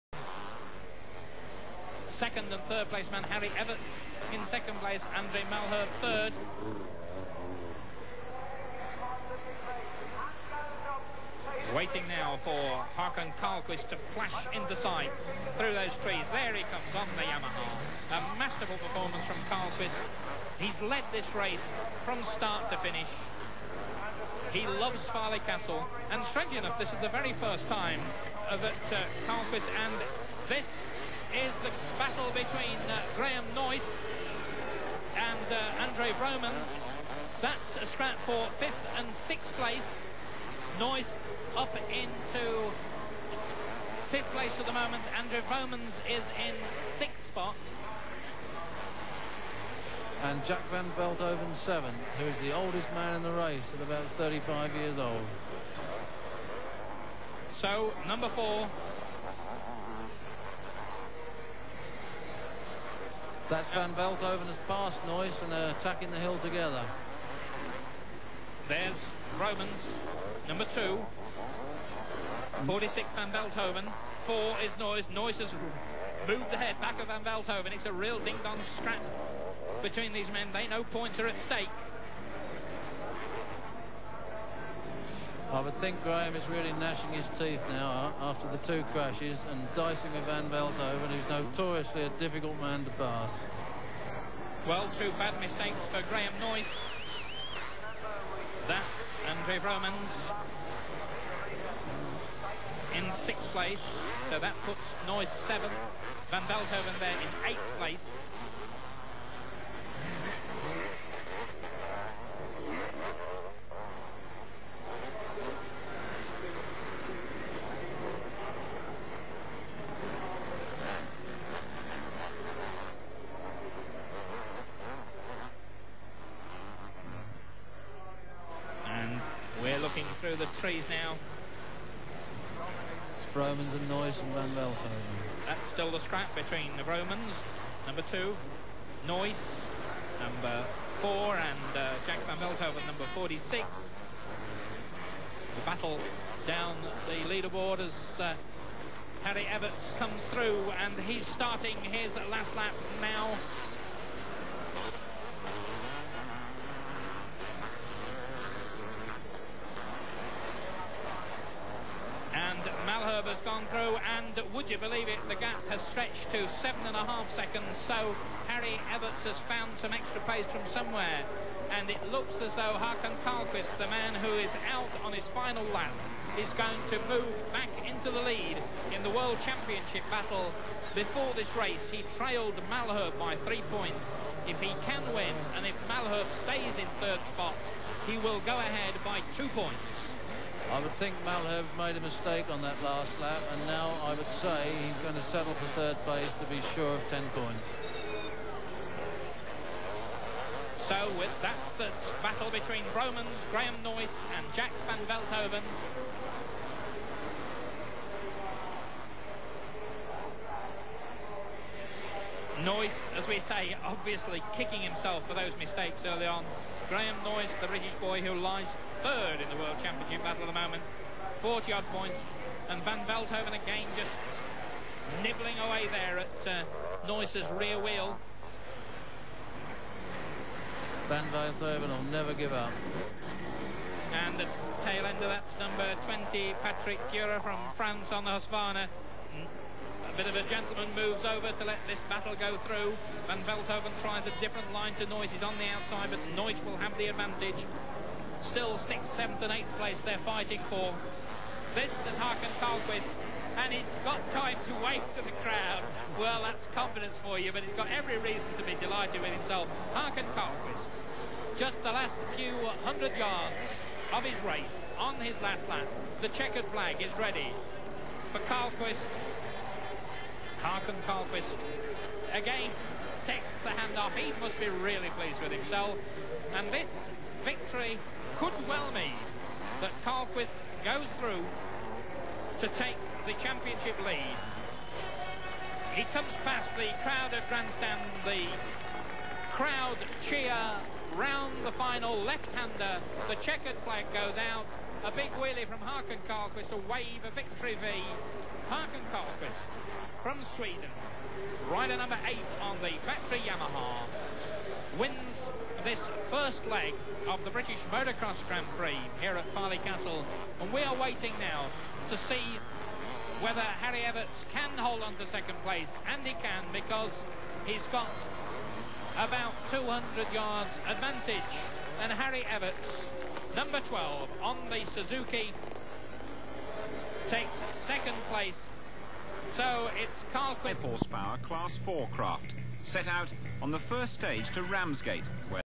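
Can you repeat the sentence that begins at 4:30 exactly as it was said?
Hakan Carlqvist, again, takes the hand off.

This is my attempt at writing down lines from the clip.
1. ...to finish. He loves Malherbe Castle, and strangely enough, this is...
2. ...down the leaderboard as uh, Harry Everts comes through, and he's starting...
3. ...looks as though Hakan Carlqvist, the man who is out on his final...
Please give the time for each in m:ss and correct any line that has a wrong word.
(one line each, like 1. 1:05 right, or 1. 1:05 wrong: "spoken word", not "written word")
1. 0:22 wrong: "Farleigh", not "Malherbe"
2. 2:26 right
3. 2:52 right.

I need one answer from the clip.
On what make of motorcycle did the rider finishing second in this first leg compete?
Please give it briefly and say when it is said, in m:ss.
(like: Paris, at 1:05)
Suzuki, at 5:24.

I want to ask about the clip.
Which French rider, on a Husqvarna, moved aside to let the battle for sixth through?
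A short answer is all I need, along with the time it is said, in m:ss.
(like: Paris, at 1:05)
Patrick Cura, at 3:56.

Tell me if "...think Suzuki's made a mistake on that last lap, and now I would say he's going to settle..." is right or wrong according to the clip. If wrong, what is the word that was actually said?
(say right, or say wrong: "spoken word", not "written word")
wrong: "Malherbe", not "Suzuki".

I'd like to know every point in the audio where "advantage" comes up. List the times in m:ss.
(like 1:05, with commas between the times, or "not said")
4:07, 5:20.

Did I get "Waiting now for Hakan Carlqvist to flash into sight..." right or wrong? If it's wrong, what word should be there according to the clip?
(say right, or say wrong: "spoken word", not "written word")
right.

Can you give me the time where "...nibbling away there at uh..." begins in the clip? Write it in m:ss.
3:45.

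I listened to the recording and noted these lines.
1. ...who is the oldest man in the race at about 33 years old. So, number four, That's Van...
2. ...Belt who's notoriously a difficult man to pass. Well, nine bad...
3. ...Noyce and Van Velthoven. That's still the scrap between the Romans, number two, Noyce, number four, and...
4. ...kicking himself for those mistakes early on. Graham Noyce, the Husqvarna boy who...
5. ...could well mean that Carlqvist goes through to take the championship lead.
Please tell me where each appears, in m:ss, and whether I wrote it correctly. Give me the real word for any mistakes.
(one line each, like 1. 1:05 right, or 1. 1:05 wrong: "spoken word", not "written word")
1. 0:52 wrong: "35", not "33"
2. 1:30 wrong: "two", not "nine"
3. 2:13 right
4. 3:34 wrong: "British", not "Husqvarna"
5. 4:38 right.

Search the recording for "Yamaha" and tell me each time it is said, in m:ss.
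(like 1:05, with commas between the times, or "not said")
0:17, 5:03.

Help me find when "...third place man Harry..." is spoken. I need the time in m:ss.
0:02.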